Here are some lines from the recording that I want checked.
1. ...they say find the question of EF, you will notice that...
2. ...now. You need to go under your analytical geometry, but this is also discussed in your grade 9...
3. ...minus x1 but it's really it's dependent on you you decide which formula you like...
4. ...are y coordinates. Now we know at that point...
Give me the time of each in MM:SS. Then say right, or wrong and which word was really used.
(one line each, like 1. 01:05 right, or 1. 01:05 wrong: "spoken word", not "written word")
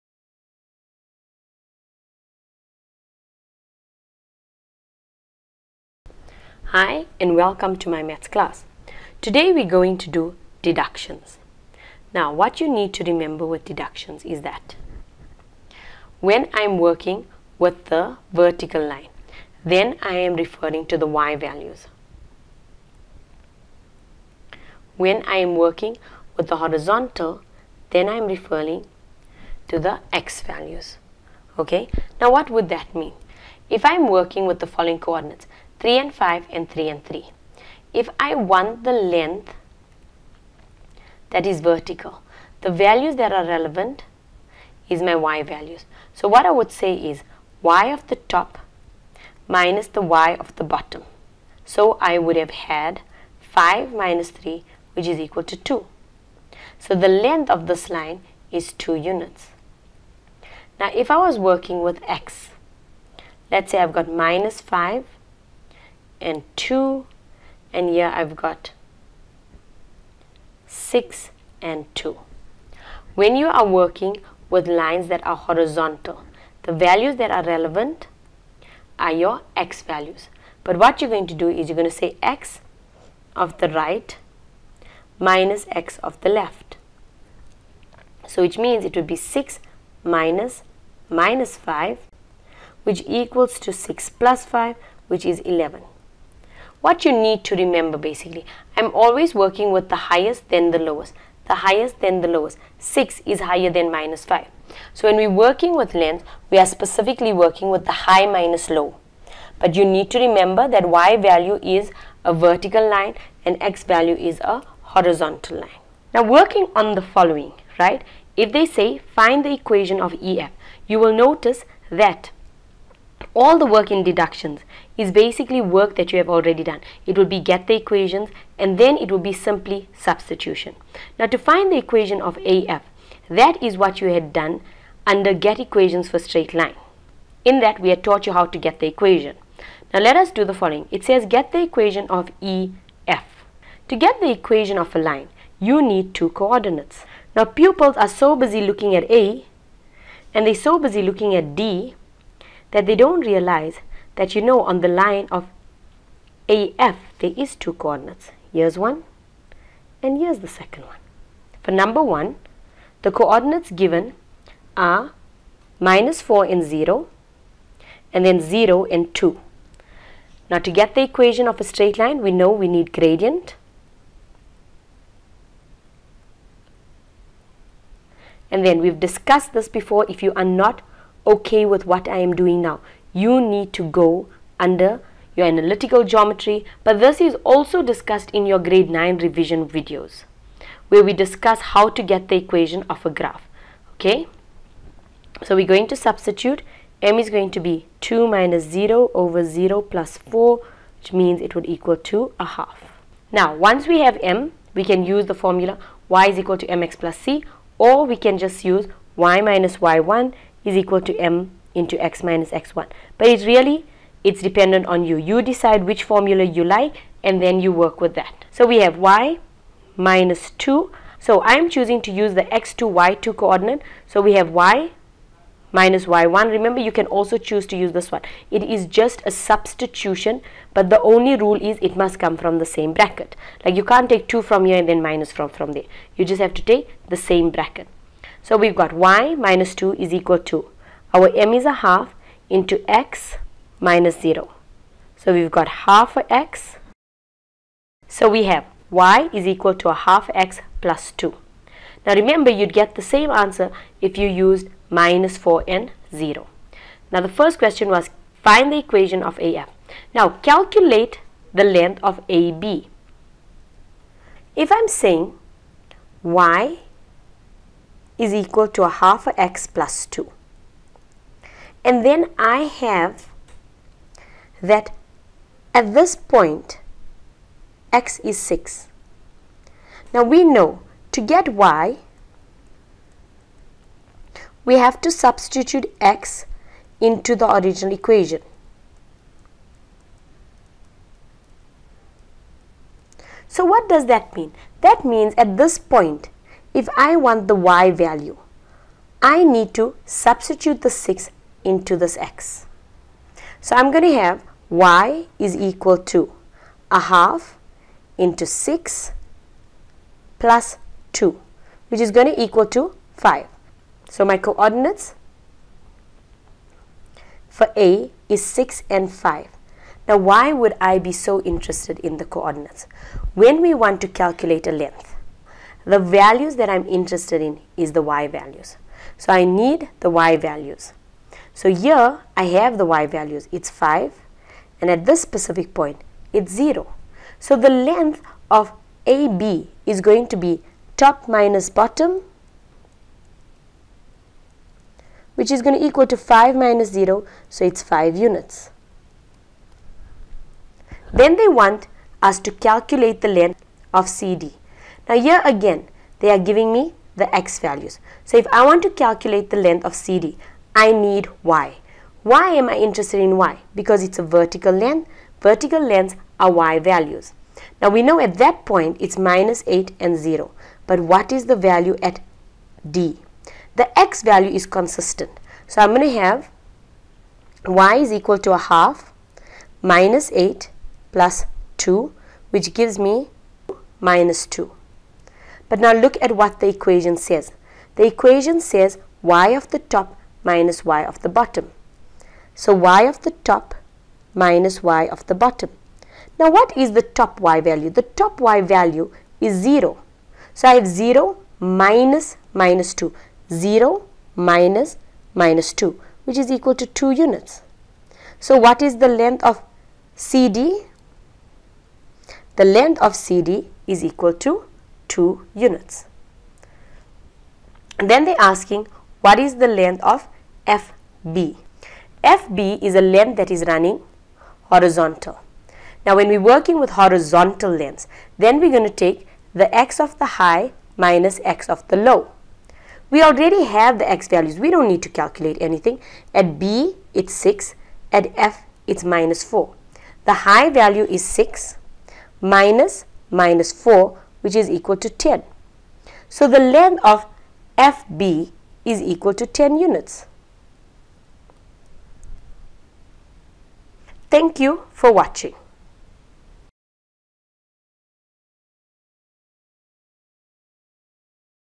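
1. 01:58 wrong: "equation", not "question"
2. 03:02 right
3. 03:32 right
4. 06:06 wrong: "values", not "coordinates".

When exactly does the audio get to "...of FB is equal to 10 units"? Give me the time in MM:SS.
07:27.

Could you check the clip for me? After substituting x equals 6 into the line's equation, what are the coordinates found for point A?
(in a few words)
(6, 5).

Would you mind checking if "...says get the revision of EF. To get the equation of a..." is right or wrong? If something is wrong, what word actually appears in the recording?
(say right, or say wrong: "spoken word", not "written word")
wrong: "equation", not "revision".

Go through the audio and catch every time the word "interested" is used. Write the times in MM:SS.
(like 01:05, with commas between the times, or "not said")
05:21, 05:26, 06:02.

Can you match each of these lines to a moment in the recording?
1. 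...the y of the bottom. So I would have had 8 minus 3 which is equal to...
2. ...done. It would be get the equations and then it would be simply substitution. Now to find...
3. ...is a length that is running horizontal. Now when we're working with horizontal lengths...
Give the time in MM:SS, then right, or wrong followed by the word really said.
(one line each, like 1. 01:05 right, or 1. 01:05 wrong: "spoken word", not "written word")
1. 00:49 wrong: "5", not "8"
2. 02:06 right
3. 07:02 right.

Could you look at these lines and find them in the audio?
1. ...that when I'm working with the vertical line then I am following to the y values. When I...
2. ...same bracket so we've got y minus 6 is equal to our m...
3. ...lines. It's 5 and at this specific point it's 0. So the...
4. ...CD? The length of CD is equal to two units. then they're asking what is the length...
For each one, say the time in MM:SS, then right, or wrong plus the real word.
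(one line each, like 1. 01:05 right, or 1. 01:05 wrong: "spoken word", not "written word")
1. 00:14 wrong: "referring", not "following"
2. 03:57 wrong: "2", not "6"
3. 05:33 wrong: "values", not "lines"
4. 06:50 right.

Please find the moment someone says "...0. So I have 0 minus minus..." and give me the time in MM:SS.
06:39.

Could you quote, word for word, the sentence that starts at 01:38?
I'm always working with the highest then the lowest.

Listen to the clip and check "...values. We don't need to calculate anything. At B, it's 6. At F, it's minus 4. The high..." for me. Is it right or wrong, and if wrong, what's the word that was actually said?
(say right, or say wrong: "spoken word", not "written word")
right.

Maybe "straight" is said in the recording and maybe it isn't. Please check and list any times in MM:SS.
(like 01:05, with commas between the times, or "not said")
02:16, 02:51.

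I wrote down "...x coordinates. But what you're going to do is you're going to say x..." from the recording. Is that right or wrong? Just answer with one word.
wrong.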